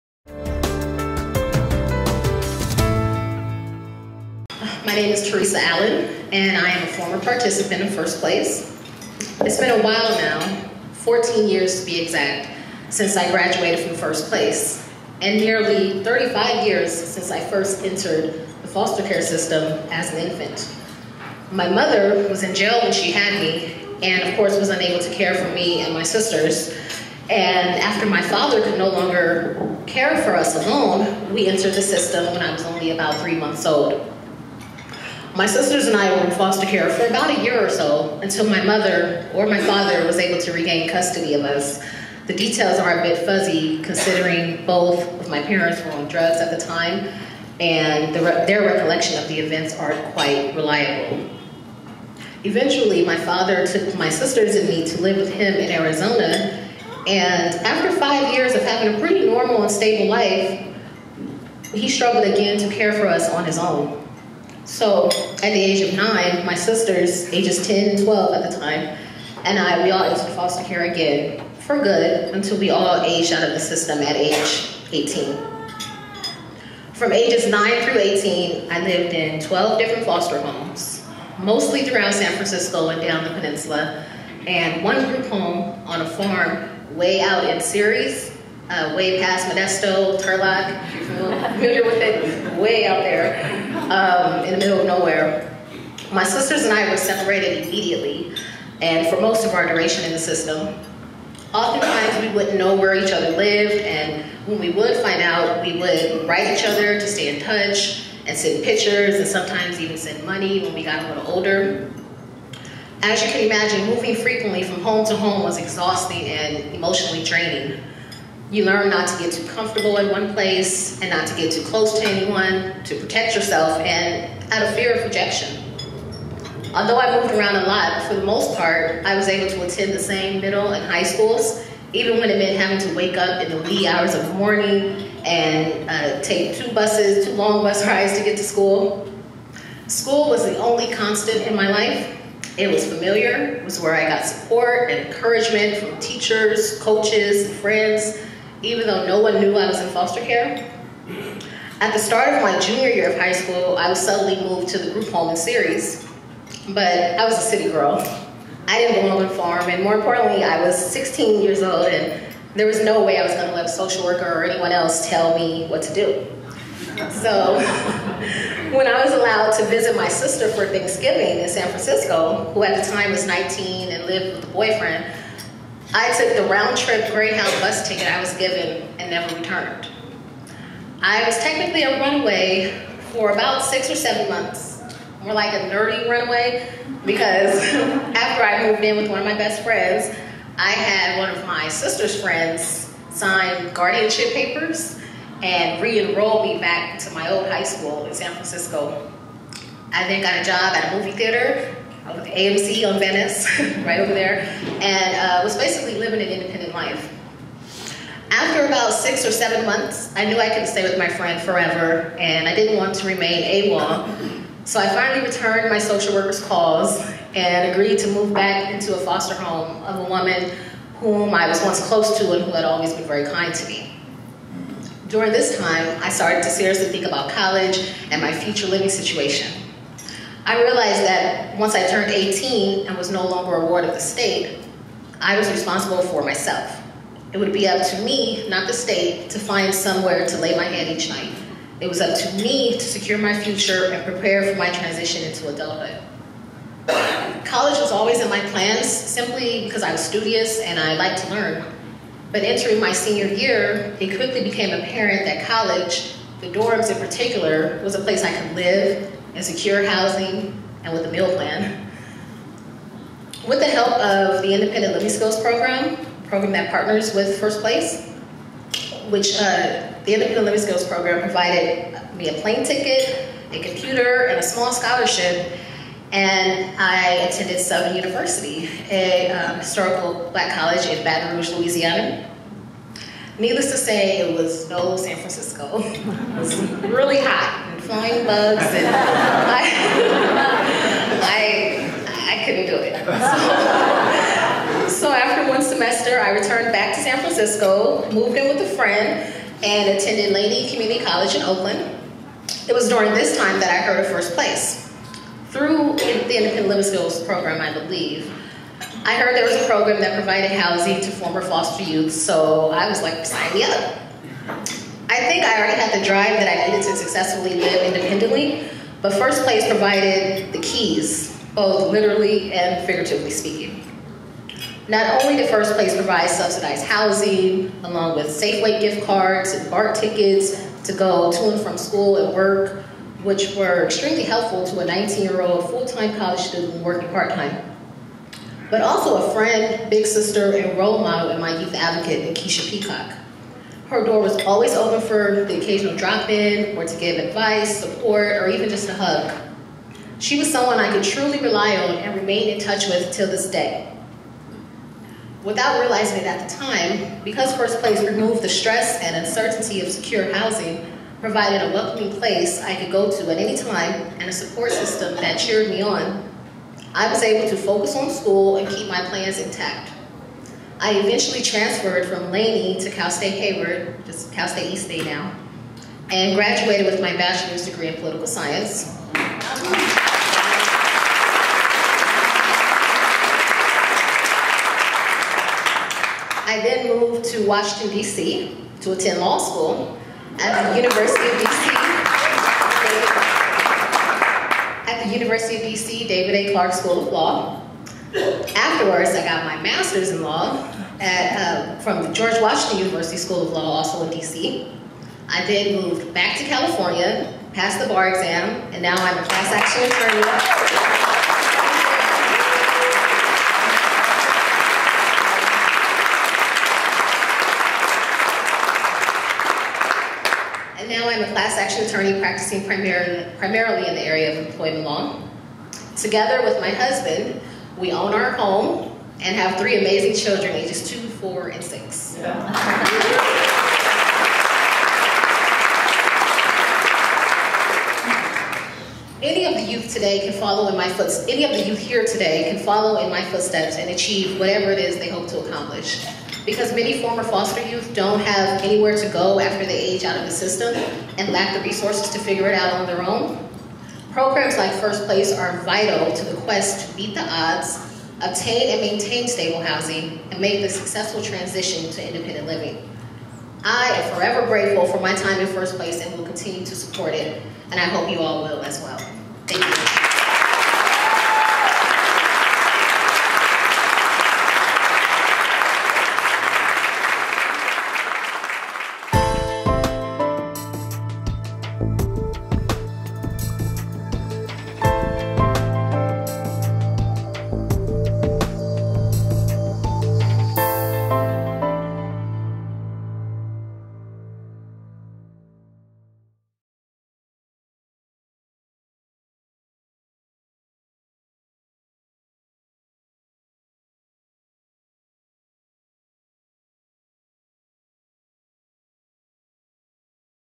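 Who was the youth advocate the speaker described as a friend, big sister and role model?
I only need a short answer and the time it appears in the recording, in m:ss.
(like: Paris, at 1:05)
Keisha Peacock, at 5:42.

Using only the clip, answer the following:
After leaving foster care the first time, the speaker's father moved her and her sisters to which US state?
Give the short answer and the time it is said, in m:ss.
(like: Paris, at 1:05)
Arizona, at 0:55.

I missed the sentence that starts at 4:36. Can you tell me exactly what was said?
And I attended Southern University, a um, historical black college in Baton Rouge, Louisiana.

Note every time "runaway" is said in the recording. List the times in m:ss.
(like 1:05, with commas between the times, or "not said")
3:01, 3:06.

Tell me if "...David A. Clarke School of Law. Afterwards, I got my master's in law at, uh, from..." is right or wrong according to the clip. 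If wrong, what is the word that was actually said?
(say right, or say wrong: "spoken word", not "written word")
right.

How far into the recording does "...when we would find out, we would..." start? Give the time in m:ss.
1:44.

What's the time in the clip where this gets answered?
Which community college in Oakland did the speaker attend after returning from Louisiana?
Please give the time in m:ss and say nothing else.
5:00.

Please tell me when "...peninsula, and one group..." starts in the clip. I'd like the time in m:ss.
1:23.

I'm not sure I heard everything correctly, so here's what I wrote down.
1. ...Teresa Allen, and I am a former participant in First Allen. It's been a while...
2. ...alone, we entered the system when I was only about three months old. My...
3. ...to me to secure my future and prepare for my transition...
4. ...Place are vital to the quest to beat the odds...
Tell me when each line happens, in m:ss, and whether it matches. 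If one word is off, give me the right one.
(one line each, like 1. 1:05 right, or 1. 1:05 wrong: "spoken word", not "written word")
1. 0:05 wrong: "Place", not "Allen"
2. 0:30 right
3. 4:02 right
4. 7:35 right.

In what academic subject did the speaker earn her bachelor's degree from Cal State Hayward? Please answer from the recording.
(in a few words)
political science.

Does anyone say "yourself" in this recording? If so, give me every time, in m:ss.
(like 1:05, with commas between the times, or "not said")
2:03.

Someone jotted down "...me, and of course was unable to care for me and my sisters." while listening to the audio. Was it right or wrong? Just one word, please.
right.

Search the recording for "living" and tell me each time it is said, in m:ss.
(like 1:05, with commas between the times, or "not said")
3:25, 3:48, 4:24, 4:30, 5:06, 7:42.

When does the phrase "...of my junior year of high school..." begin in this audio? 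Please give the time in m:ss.
2:32.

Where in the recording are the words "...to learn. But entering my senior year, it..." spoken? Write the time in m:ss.
4:11.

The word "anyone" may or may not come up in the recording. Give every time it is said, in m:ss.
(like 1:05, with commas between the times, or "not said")
2:02, 2:44.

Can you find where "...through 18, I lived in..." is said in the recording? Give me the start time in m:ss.
1:17.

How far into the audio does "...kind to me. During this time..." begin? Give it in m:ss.
3:43.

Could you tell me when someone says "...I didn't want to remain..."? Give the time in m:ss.
3:32.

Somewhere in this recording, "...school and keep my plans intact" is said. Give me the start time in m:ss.
6:08.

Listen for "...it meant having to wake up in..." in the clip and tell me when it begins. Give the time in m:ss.
2:12.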